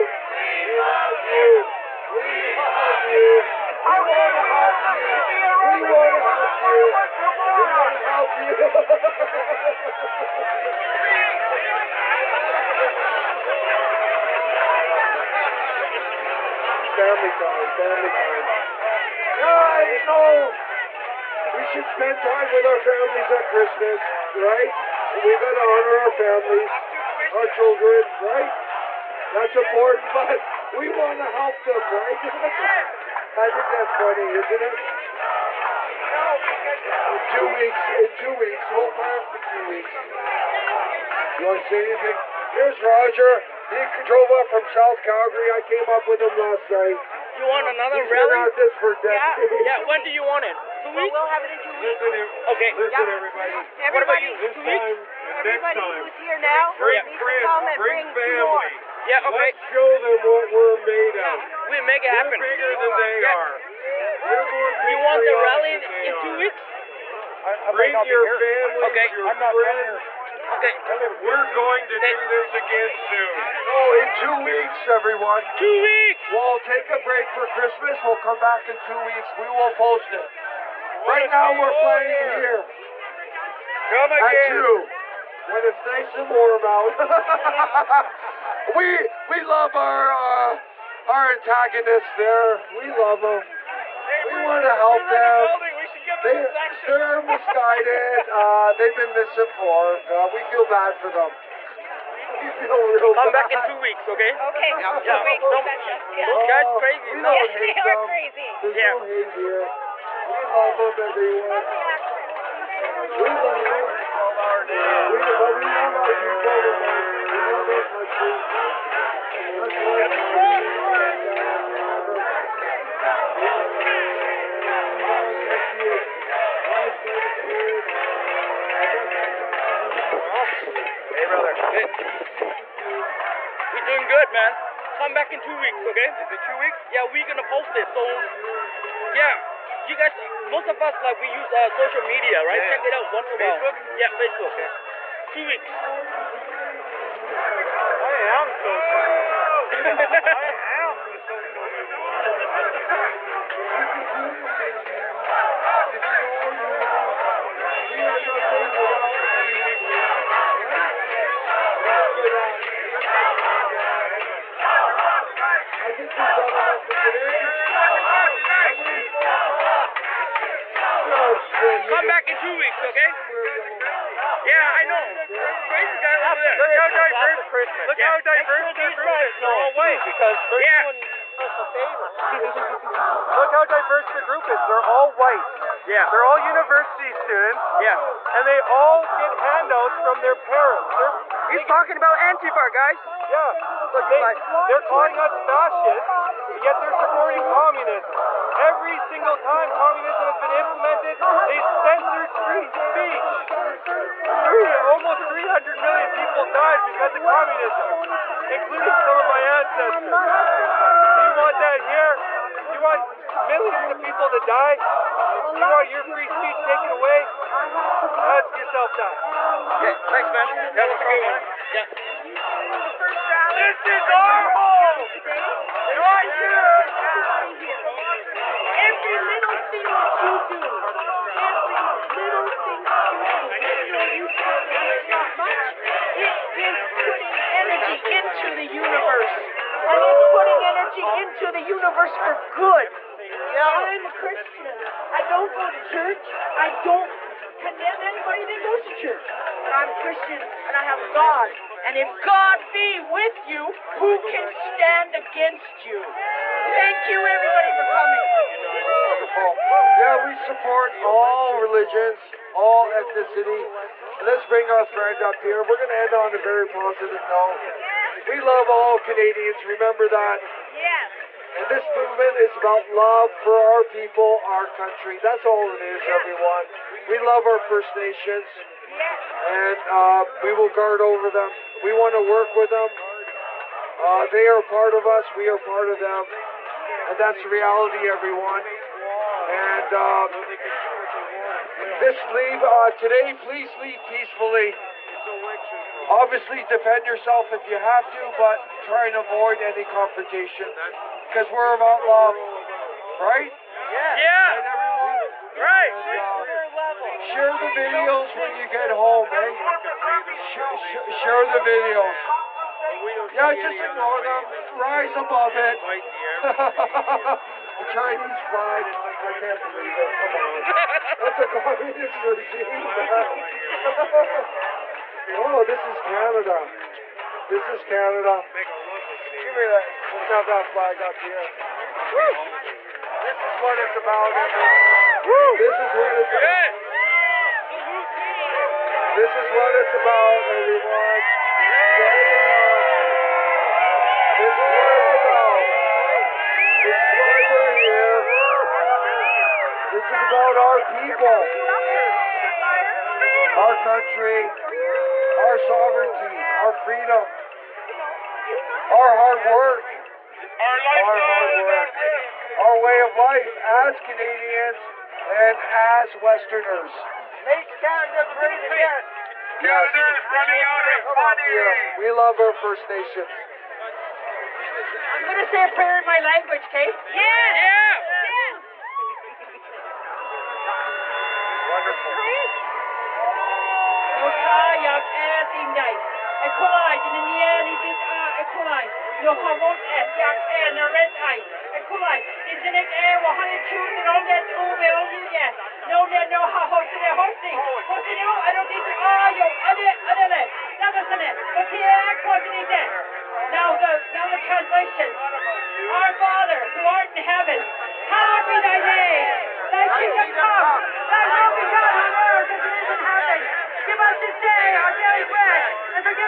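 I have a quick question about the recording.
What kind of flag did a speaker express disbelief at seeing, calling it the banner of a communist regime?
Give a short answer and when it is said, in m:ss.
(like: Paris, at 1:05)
Chinese flag, at 5:17.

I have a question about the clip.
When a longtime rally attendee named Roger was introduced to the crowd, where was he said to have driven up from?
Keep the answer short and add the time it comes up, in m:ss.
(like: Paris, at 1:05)
South Calgary, at 0:44.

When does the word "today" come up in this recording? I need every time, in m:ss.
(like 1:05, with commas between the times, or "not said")
2:47, 4:52.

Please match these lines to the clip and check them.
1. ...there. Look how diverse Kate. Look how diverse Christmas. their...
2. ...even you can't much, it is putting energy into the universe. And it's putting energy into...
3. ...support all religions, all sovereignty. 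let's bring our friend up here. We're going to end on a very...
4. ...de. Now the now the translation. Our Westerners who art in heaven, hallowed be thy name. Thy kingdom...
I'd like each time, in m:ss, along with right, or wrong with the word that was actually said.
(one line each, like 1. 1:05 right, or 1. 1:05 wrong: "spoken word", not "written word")
1. 2:56 wrong: "Christmas", not "Kate"
2. 3:54 right
3. 4:20 wrong: "ethnicity", not "sovereignty"
4. 6:42 wrong: "Father", not "Westerners".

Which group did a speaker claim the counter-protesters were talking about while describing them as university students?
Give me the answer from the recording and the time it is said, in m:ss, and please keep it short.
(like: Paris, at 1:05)
Antifa, at 3:12.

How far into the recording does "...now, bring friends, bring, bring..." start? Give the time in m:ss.
0:56.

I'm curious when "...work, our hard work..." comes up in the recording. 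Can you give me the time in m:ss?
5:59.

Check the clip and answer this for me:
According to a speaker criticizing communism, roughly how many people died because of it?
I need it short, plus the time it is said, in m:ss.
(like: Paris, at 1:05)
300 million, at 3:25.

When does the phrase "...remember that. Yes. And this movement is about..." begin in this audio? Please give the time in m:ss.
4:29.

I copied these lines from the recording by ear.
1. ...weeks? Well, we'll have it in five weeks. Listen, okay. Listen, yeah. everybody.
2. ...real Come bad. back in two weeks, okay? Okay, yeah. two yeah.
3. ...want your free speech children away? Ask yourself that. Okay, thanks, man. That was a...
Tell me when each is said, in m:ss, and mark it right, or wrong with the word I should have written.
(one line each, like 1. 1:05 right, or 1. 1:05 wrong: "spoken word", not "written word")
1. 0:50 wrong: "two", not "five"
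2. 1:42 right
3. 3:35 wrong: "taken", not "children".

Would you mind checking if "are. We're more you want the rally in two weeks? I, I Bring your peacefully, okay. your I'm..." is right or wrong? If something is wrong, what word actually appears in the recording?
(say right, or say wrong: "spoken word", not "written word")
wrong: "family", not "peacefully".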